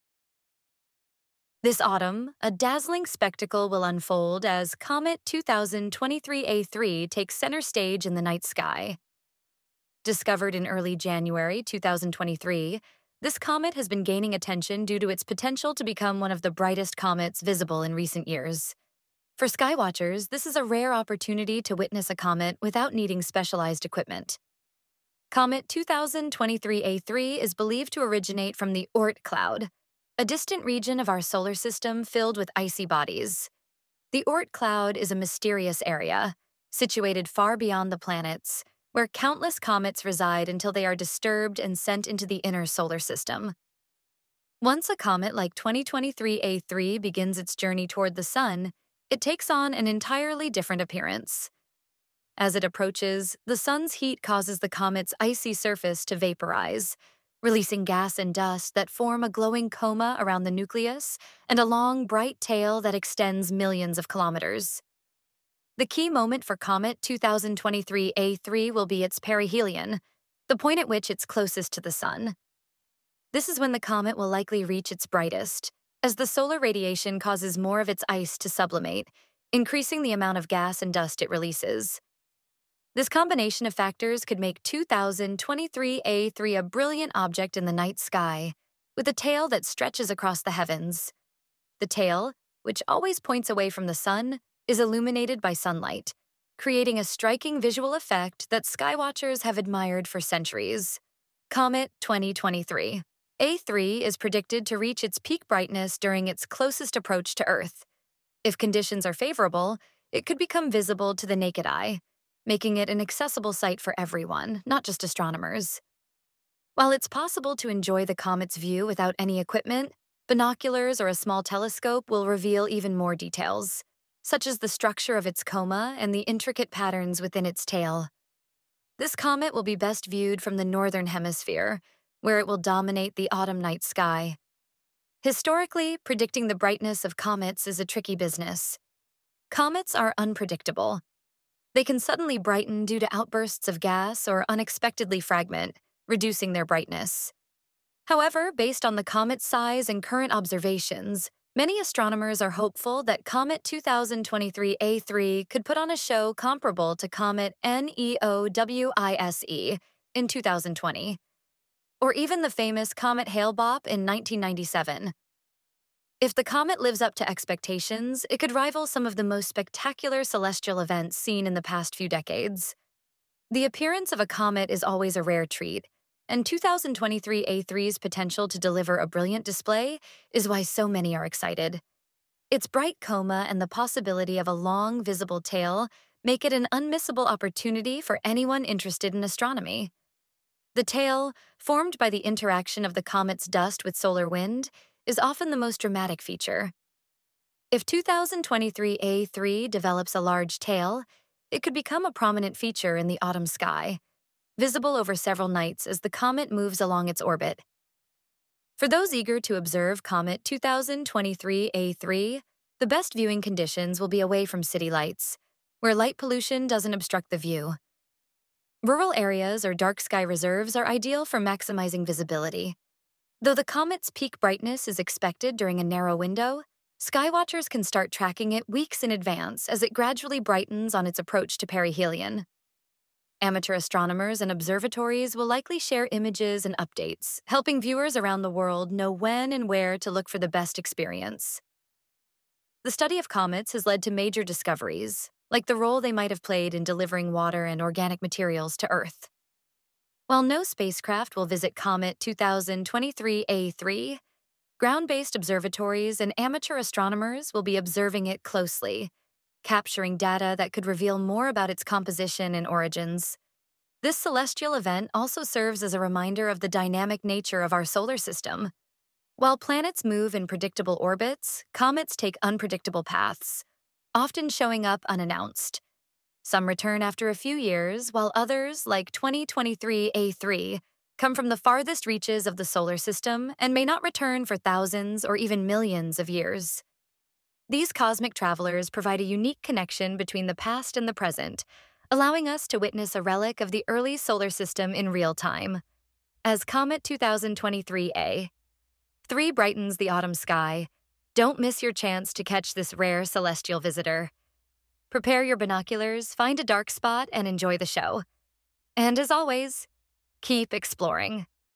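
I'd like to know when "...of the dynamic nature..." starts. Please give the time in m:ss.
4:26.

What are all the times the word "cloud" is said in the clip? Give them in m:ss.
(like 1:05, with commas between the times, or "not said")
0:29, 0:34.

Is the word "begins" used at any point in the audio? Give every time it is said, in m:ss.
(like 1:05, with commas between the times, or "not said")
0:47.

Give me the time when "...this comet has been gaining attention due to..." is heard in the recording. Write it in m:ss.
0:13.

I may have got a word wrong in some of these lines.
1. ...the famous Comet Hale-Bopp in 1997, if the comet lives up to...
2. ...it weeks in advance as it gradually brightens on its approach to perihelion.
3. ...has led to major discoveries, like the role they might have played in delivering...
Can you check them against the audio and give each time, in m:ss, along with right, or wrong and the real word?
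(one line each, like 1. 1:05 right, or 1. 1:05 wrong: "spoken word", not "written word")
1. 2:42 right
2. 3:48 right
3. 4:03 right.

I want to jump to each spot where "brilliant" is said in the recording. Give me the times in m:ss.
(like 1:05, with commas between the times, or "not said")
1:26, 2:59.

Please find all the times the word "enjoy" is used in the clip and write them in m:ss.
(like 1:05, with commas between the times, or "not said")
1:57, 5:07.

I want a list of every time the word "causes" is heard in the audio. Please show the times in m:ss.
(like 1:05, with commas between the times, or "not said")
0:54, 1:17.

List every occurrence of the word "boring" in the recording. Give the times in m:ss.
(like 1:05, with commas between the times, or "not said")
not said.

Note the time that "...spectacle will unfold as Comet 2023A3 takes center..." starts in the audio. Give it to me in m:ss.
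0:03.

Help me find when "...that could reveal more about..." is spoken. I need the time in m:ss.
4:20.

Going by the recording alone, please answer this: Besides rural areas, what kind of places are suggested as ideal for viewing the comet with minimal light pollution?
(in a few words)
dark sky reserves.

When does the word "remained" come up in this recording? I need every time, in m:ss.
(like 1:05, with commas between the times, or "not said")
not said.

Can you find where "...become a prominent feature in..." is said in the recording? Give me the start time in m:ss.
3:21.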